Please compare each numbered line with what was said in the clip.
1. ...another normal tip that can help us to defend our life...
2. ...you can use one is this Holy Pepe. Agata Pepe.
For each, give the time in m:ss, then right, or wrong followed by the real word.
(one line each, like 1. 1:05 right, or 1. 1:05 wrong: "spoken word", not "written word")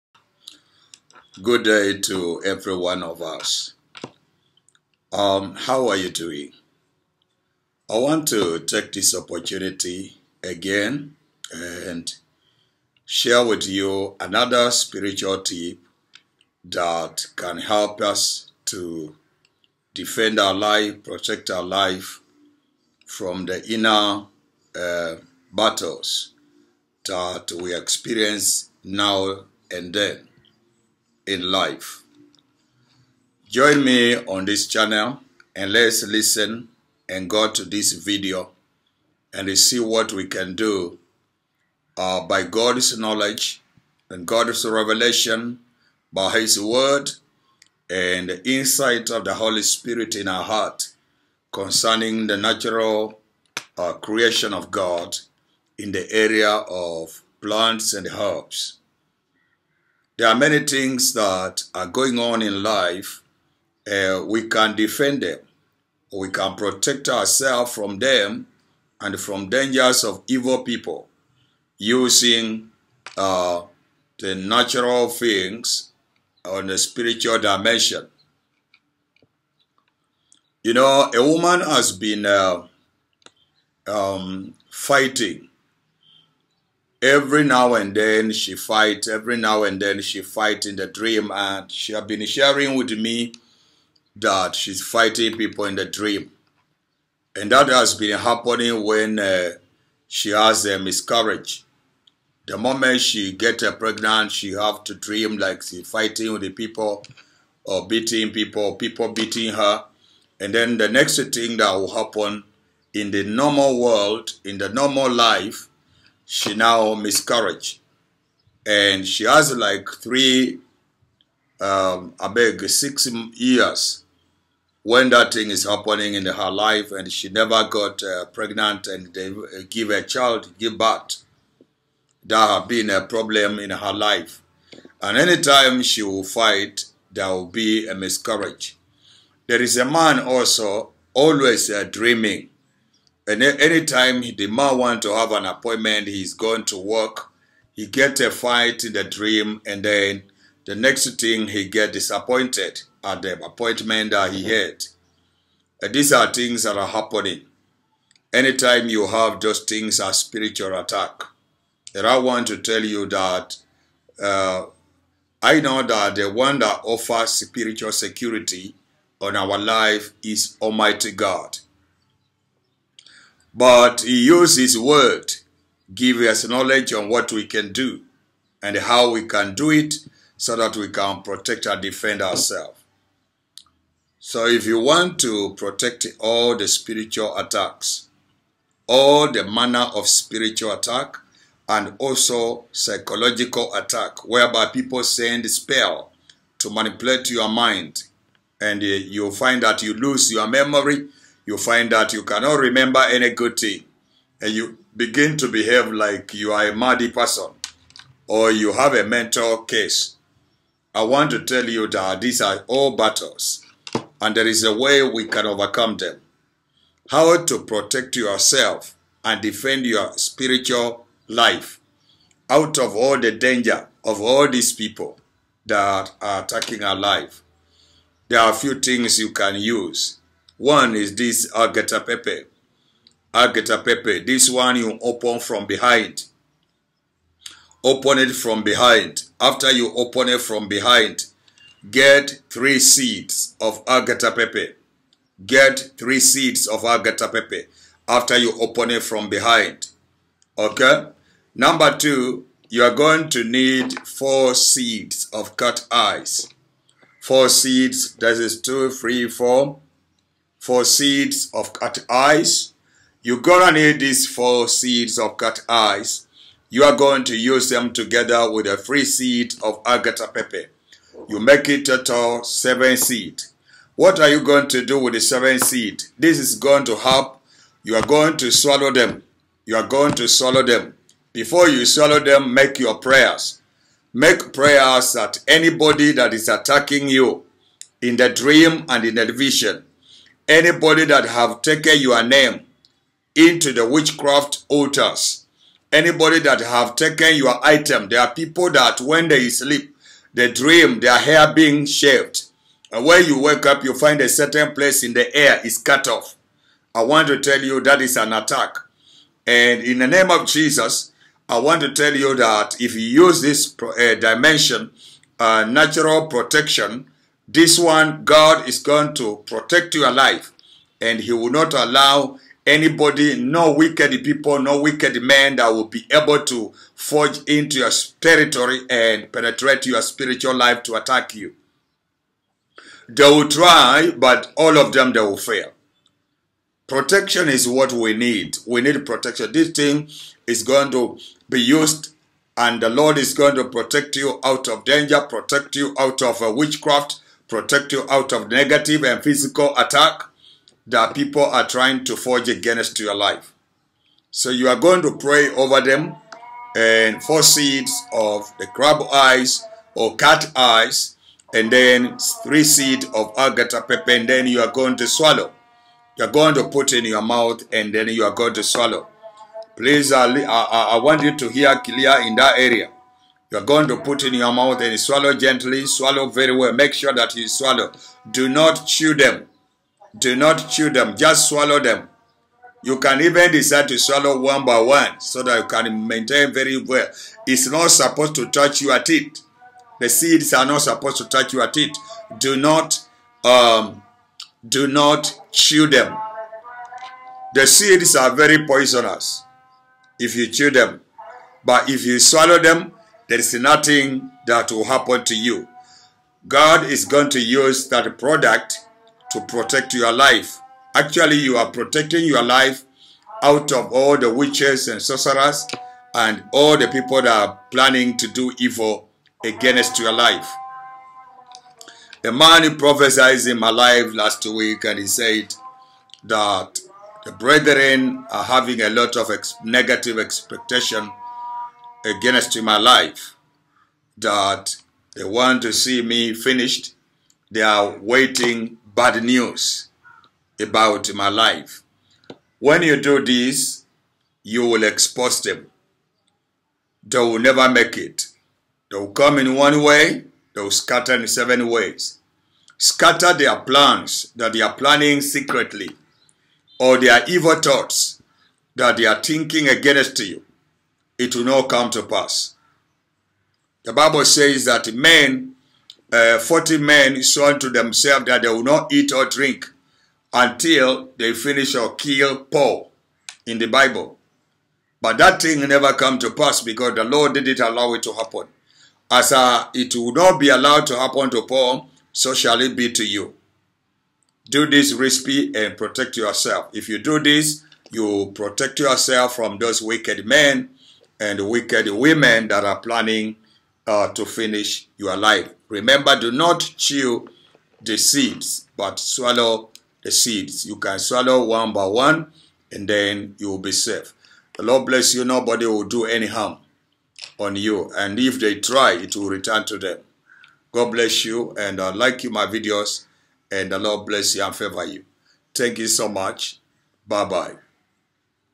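1. 0:14 wrong: "spiritual", not "normal"
2. 3:49 wrong: "Agata", not "Holy".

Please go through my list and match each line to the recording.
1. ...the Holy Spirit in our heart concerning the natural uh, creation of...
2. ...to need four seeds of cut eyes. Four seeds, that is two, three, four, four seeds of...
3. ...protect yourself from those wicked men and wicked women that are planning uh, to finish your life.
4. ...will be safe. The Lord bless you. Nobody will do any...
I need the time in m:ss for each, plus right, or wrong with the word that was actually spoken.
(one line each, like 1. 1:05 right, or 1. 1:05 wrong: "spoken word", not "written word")
1. 0:49 right
2. 4:13 right
3. 8:08 right
4. 8:23 right.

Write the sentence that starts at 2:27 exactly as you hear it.
He get a fight in the dream, and then the next thing he get disappointed at the appointment that he mm-hmm.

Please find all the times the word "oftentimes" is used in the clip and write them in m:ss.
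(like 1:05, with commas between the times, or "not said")
not said.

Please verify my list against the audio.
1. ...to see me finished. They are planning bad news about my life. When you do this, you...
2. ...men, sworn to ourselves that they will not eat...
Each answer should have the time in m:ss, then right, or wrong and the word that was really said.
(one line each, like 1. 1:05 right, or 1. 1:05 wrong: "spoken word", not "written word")
1. 7:15 wrong: "waiting", not "planning"
2. 7:46 wrong: "themselves", not "ourselves".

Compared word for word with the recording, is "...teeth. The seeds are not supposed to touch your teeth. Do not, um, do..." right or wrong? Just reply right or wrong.
right.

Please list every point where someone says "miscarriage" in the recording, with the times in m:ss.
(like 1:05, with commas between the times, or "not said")
1:40, 1:56, 2:17.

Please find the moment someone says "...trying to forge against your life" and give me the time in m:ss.
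5:51.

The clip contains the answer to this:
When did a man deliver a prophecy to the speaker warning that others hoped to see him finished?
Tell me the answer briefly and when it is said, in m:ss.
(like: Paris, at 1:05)
last week, at 7:04.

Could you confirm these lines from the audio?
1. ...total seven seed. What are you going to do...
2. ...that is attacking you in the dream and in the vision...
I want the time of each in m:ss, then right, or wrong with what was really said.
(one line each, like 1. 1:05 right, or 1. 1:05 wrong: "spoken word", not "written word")
1. 4:31 right
2. 4:46 right.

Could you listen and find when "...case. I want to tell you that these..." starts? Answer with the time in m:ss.
3:29.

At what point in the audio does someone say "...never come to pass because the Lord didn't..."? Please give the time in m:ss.
7:55.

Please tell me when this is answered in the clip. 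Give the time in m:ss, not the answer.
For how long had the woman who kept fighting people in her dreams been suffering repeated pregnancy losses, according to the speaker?
2:02.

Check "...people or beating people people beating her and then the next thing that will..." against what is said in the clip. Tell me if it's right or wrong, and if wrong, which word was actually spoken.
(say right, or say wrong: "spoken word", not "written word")
right.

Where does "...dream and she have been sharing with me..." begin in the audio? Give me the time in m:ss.
1:30.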